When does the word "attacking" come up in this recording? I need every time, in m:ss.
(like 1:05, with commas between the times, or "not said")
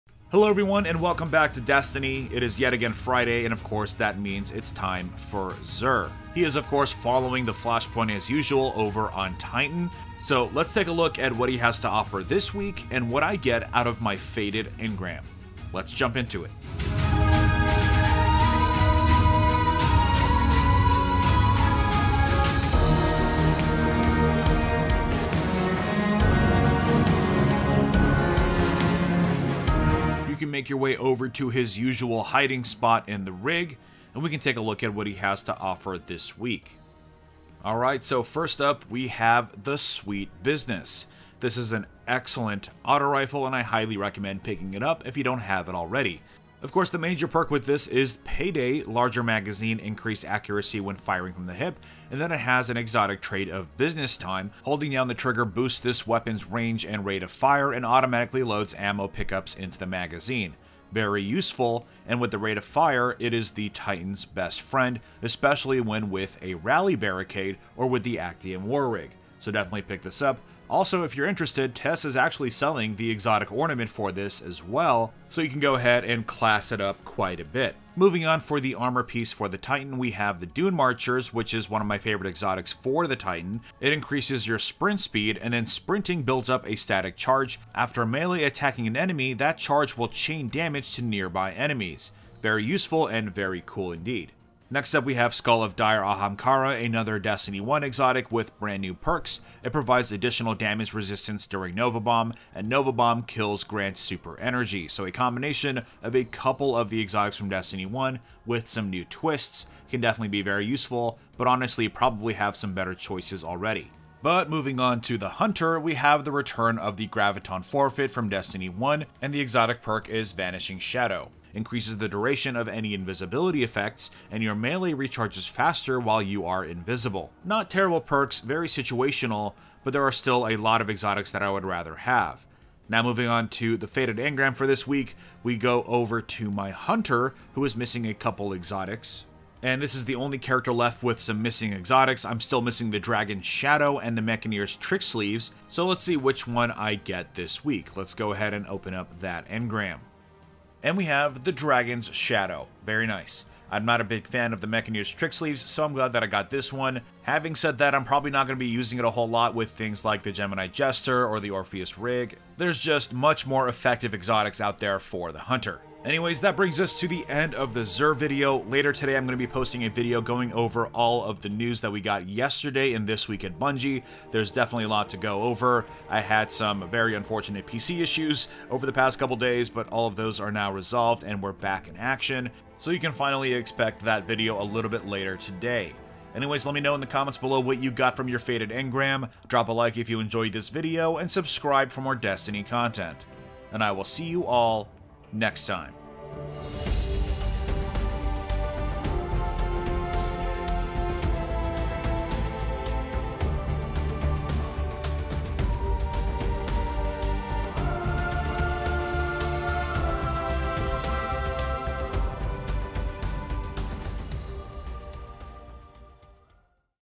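1:28.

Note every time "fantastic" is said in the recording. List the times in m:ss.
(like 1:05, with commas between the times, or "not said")
not said.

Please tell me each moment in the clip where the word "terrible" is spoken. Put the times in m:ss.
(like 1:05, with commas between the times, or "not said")
2:07.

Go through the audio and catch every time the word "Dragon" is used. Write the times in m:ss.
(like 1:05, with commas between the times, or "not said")
2:22, 2:31.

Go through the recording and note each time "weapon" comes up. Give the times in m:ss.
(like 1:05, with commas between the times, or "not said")
0:56.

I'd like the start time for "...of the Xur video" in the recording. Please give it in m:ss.
2:47.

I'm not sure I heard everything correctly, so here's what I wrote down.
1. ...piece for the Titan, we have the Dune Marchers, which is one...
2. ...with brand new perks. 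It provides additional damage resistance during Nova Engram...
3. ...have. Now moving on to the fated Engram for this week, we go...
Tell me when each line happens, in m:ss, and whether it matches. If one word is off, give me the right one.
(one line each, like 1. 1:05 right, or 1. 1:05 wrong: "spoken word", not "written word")
1. 1:19 right
2. 1:38 wrong: "Bomb", not "Engram"
3. 2:11 right.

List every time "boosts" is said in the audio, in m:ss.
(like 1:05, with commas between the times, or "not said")
0:55.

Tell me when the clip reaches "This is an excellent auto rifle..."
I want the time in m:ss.
0:41.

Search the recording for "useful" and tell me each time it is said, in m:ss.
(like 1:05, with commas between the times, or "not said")
1:01, 1:32, 1:50.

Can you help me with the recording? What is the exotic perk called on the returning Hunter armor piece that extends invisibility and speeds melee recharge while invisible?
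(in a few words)
Vanishing Shadow.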